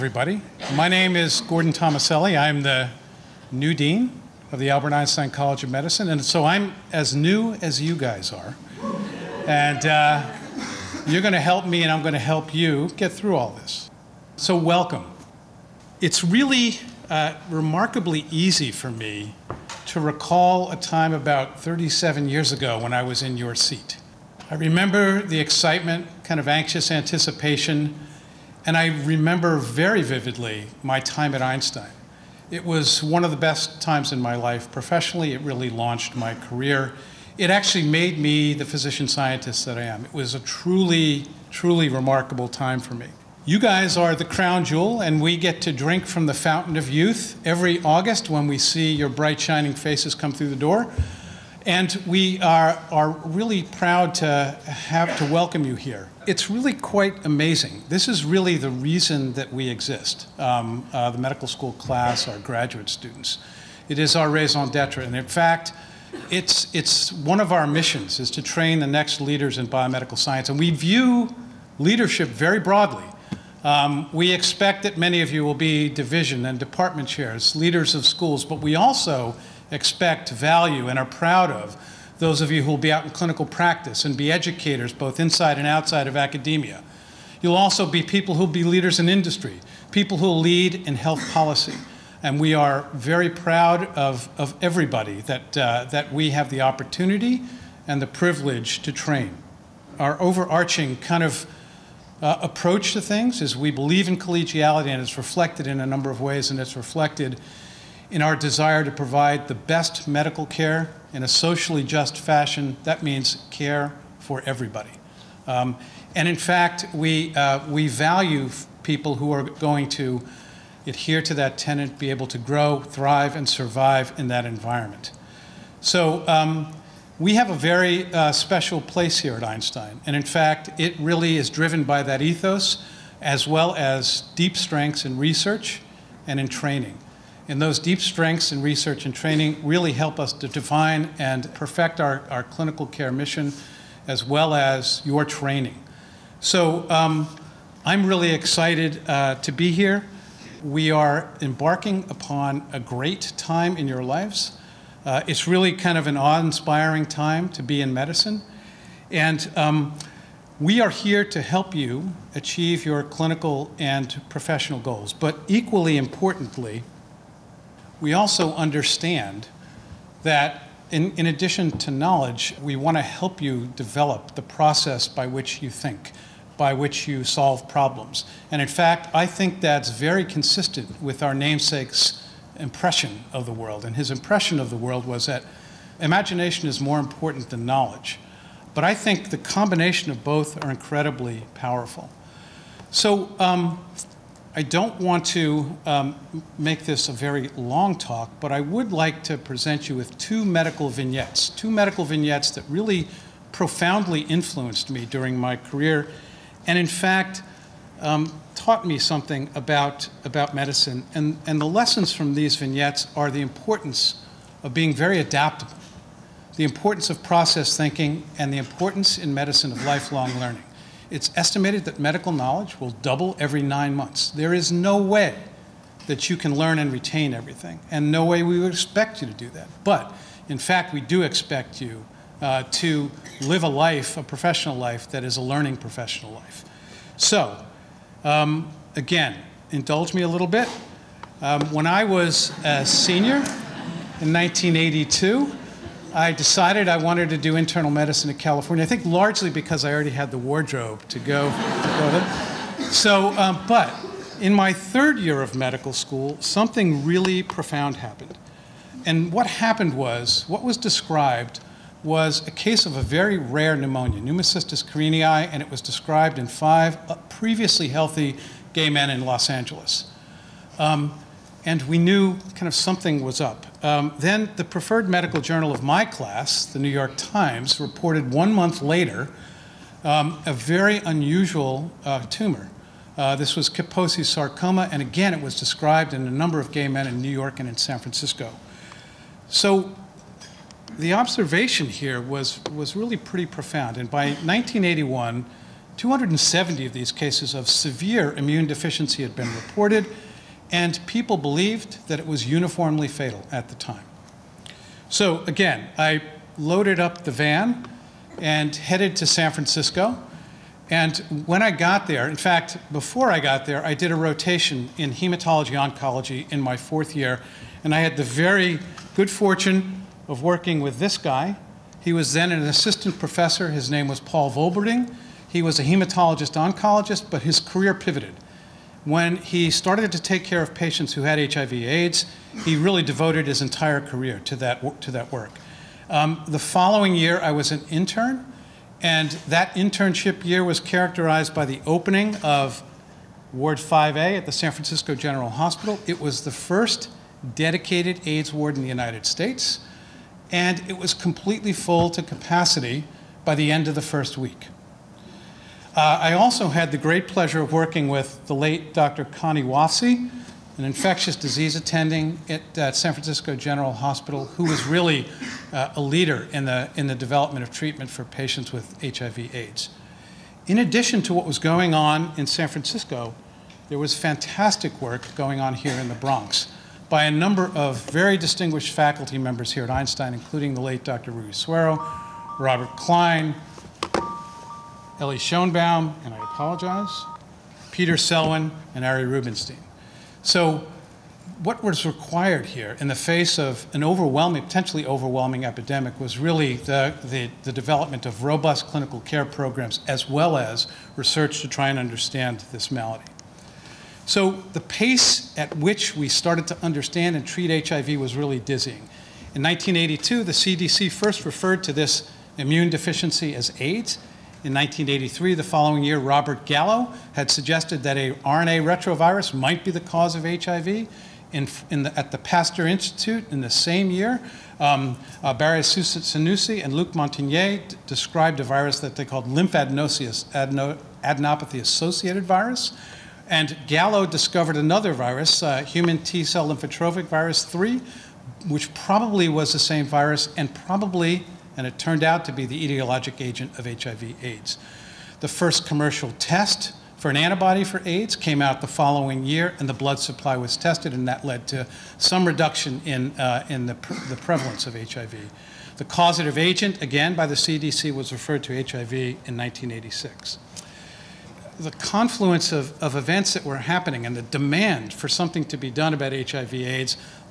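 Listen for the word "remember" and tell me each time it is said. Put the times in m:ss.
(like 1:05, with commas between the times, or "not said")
0:24, 0:29.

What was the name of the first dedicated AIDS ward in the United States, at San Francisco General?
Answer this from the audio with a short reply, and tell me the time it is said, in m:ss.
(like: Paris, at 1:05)
Ward 5A, at 5:43.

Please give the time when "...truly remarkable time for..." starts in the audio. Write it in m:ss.
0:41.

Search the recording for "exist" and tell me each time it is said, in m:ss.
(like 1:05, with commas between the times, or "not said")
0:59.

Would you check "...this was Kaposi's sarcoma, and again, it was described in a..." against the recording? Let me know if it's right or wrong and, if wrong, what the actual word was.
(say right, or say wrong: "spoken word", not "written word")
right.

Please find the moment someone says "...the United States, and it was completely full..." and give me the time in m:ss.
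5:48.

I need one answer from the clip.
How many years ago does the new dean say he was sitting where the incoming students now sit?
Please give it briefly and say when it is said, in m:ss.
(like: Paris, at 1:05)
37, at 0:21.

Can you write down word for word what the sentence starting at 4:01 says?
Um, when I was a senior in 1982, I decided I wanted to do internal medicine in California.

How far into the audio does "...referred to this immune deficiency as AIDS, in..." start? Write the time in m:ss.
6:51.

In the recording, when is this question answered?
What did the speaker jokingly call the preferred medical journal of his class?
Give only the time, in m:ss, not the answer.
4:36.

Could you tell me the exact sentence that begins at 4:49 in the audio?
So the observation here was, was really pretty profound.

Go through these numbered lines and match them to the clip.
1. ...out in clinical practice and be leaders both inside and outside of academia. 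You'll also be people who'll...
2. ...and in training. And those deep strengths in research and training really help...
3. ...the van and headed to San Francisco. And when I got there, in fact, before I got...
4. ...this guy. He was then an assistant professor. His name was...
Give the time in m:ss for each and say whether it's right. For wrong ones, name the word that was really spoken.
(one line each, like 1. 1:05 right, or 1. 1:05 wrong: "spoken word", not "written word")
1. 1:22 wrong: "educators", not "leaders"
2. 2:16 right
3. 5:07 right
4. 5:20 right.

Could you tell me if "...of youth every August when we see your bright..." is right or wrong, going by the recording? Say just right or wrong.
right.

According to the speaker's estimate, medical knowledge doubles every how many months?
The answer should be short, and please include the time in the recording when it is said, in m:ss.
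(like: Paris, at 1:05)
9, at 3:43.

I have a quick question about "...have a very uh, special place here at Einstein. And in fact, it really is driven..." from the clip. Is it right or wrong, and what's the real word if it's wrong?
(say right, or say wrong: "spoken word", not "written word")
right.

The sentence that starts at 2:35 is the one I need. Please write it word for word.
Uh, it's really kind of an awe inspiring time to be in medicine.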